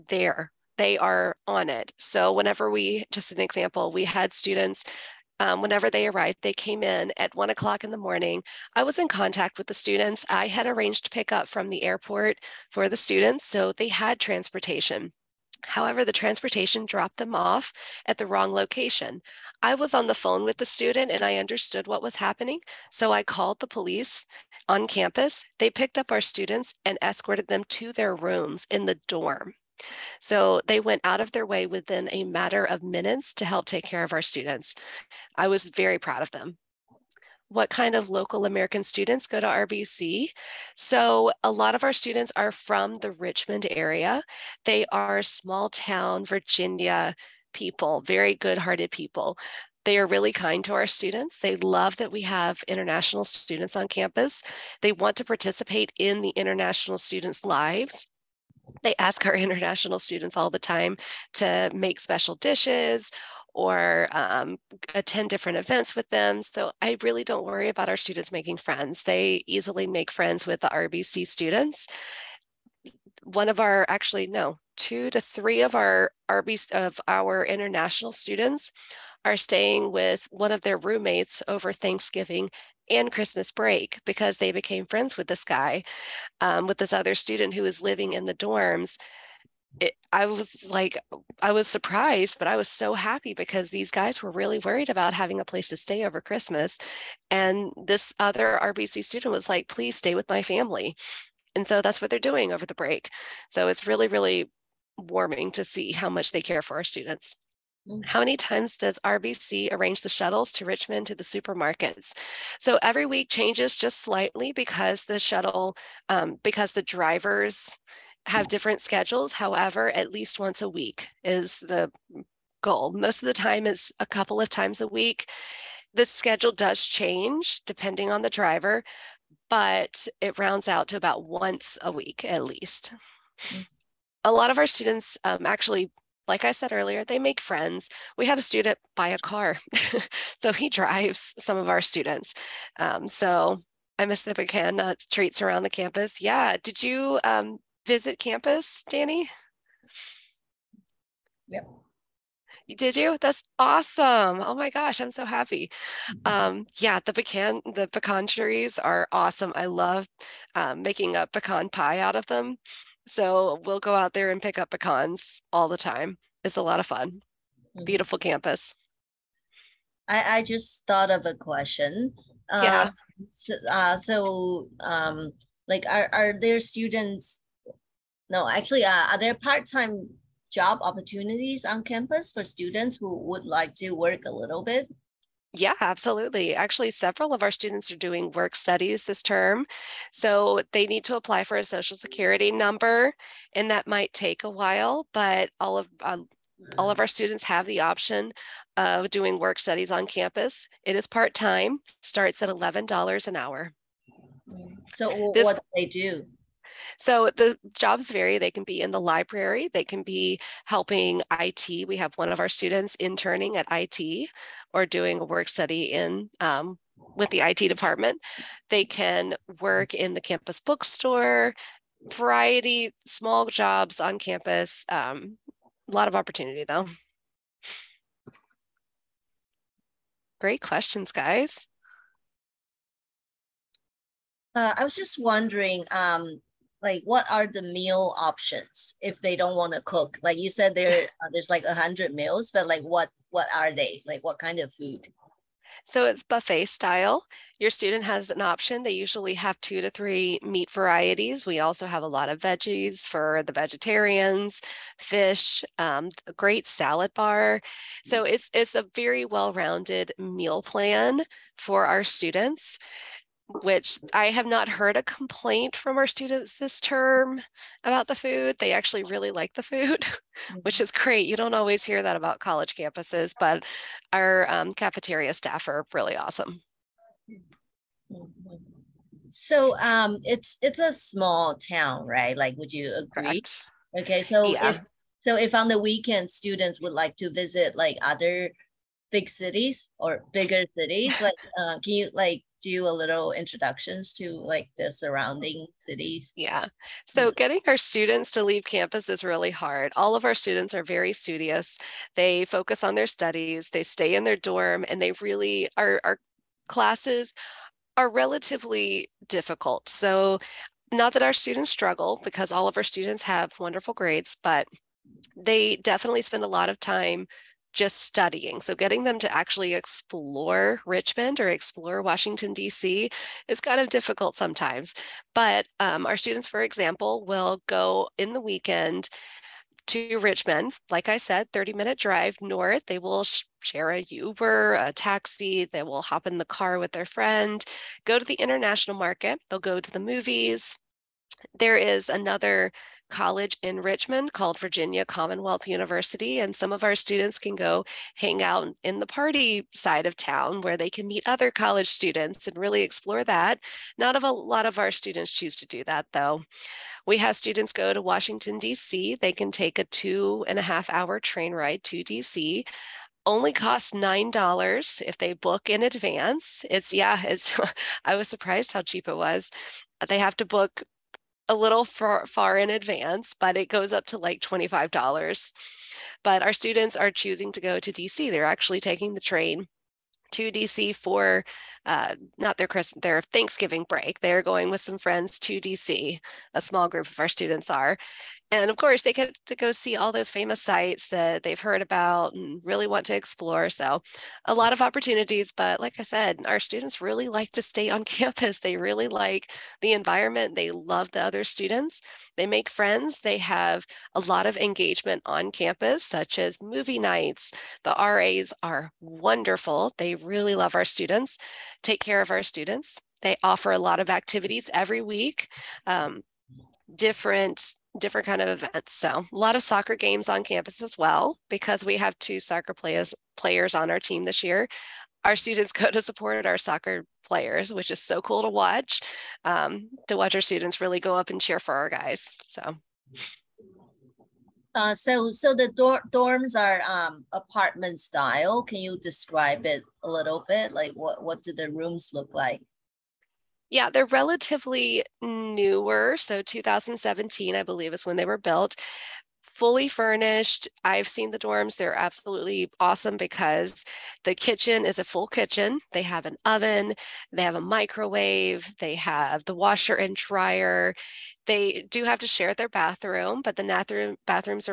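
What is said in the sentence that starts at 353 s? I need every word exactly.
Not a lot of our students choose to do that though.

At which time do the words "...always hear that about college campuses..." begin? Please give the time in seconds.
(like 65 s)
271 s.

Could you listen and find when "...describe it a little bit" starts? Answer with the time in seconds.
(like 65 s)
438 s.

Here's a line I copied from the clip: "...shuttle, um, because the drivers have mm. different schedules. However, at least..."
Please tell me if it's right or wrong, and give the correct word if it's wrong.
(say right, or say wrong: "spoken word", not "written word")
right.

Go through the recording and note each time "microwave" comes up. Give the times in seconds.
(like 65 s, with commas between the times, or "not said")
457 s.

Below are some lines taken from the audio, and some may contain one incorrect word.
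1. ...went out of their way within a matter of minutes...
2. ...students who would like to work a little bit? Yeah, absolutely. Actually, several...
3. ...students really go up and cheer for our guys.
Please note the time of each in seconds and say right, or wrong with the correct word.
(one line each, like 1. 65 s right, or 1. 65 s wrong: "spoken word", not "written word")
1. 30 s right
2. 182 s right
3. 430 s right.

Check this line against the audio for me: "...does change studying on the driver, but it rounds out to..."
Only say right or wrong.
wrong.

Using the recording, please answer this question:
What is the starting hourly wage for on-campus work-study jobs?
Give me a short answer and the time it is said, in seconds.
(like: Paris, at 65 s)
$11, at 202 s.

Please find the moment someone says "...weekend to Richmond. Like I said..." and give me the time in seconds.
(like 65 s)
328 s.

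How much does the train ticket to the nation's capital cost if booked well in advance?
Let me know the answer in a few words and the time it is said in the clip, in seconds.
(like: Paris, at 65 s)
$9, at 363 s.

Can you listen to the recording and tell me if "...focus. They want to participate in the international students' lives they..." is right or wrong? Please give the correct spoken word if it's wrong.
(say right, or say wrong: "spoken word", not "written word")
wrong: "campus", not "focus".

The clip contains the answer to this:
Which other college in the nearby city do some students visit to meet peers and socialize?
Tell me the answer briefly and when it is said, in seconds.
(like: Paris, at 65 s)
Virginia Commonwealth University, at 344 s.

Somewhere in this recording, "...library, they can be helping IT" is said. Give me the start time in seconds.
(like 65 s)
208 s.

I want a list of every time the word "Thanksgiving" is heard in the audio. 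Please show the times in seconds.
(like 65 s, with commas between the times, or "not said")
81 s, 383 s.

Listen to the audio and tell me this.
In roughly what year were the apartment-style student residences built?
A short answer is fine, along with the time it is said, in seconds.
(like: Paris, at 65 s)
2017, at 446 s.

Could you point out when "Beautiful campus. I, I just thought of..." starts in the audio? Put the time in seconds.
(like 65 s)
167 s.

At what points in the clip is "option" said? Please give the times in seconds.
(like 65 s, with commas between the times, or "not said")
197 s, 238 s, 248 s.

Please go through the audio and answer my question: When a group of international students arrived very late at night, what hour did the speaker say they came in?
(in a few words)
1 a.m.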